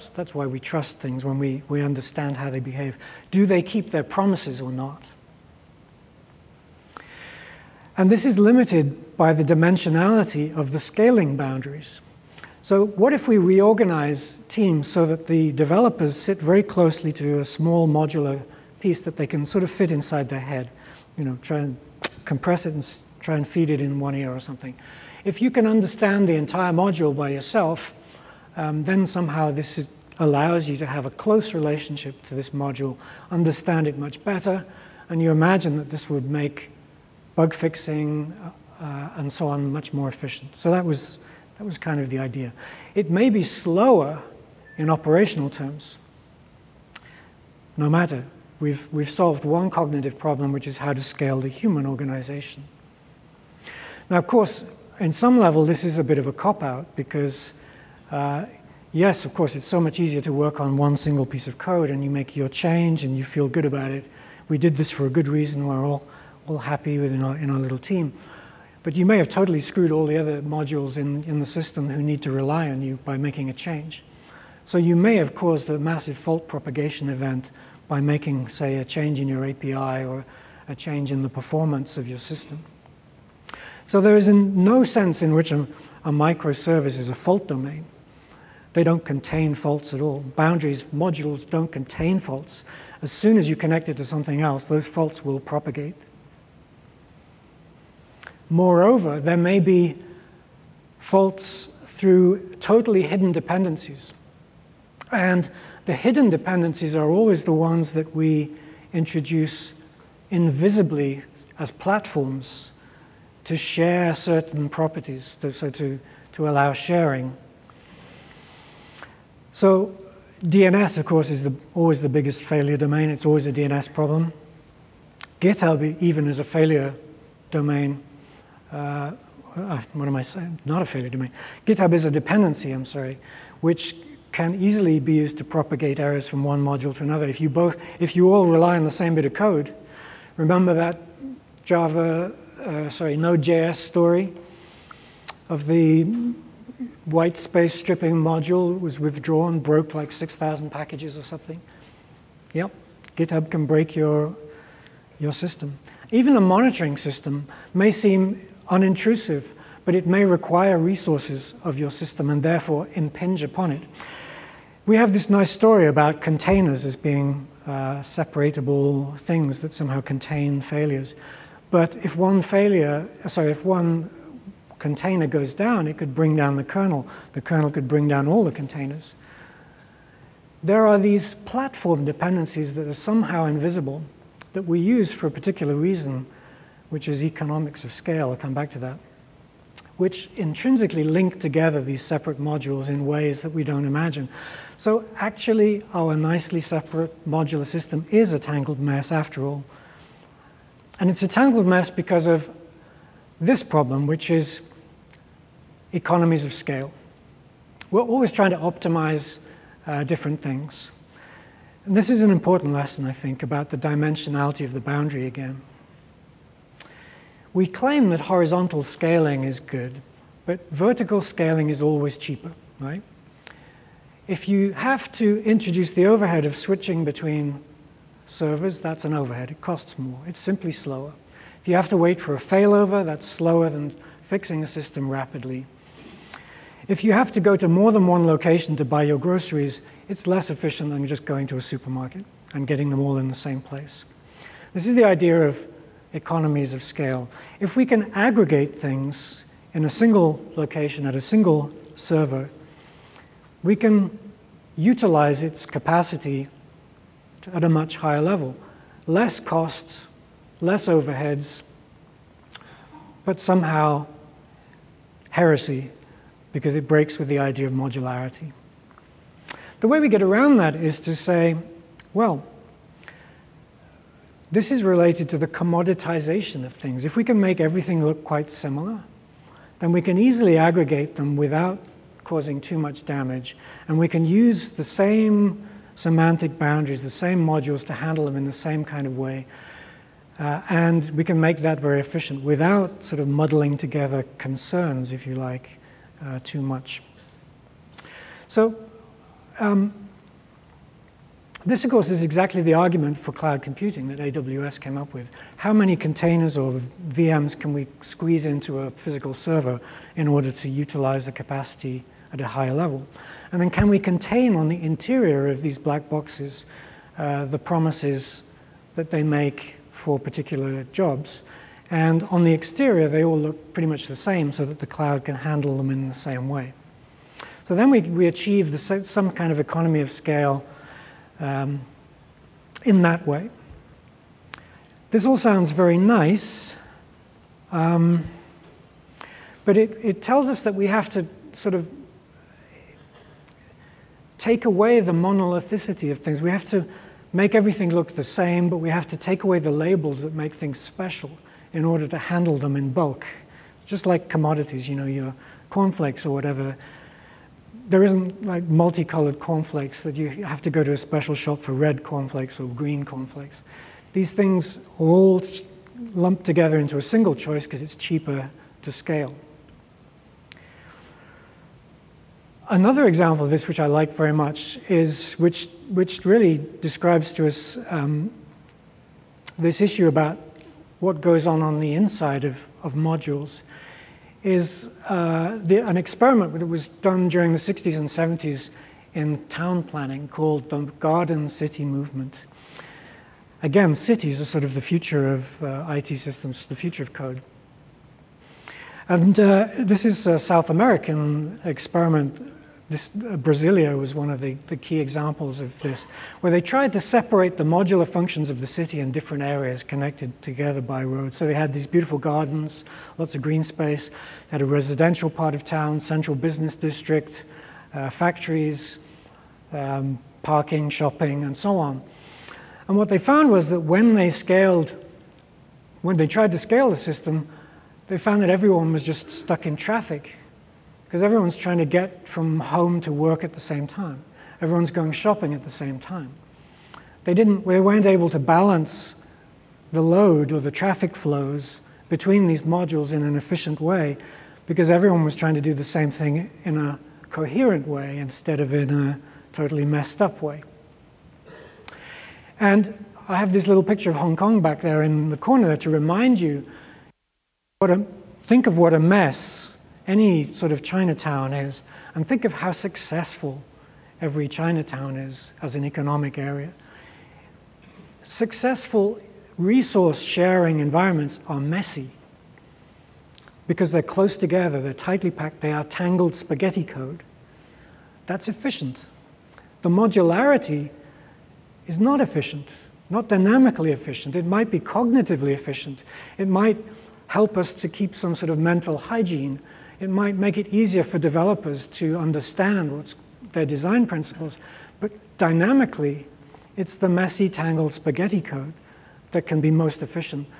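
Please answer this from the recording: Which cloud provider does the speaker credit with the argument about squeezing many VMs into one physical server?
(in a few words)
AWS.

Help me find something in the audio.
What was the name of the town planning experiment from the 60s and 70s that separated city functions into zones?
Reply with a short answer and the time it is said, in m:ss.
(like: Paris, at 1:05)
Garden City Movement, at 6:30.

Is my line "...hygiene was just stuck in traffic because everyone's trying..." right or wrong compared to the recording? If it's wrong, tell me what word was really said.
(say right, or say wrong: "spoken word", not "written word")
wrong: "everyone", not "hygiene".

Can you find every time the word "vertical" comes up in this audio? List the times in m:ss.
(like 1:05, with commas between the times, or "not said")
3:40.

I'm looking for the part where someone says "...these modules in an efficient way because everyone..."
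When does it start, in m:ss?
7:22.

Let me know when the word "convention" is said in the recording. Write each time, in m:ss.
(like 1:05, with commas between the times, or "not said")
not said.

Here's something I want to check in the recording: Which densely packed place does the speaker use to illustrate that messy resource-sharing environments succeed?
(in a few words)
Hong Kong.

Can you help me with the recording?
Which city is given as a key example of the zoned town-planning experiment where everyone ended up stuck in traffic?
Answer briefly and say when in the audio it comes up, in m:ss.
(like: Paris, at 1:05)
Brasilia, at 6:43.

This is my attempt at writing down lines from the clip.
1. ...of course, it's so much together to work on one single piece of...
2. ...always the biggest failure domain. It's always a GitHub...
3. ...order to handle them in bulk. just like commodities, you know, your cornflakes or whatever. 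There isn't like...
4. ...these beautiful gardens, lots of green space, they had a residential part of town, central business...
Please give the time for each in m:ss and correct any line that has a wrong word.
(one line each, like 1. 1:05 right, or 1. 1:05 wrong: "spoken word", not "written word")
1. 0:59 wrong: "easier", not "together"
2. 2:01 wrong: "DNS", not "GitHub"
3. 5:51 right
4. 6:51 right.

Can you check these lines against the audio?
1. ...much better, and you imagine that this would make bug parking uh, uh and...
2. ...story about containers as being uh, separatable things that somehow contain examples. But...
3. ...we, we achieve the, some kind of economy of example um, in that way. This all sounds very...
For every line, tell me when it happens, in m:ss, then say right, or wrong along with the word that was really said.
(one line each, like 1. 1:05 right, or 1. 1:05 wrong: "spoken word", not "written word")
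1. 0:33 wrong: "fixing", not "parking"
2. 2:45 wrong: "failures", not "examples"
3. 5:27 wrong: "scale", not "example".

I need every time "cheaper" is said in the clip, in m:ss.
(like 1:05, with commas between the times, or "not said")
3:42, 6:07.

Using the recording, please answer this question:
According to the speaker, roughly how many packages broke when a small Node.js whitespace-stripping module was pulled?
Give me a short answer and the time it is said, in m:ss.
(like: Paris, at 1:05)
6,000, at 2:30.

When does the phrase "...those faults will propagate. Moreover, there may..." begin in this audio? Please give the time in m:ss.
1:34.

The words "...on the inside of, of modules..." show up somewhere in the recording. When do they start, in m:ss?
6:21.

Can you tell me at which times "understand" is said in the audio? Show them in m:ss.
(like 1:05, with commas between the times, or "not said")
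0:01, 0:25, 0:33, 8:12.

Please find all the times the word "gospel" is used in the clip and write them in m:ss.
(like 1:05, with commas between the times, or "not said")
not said.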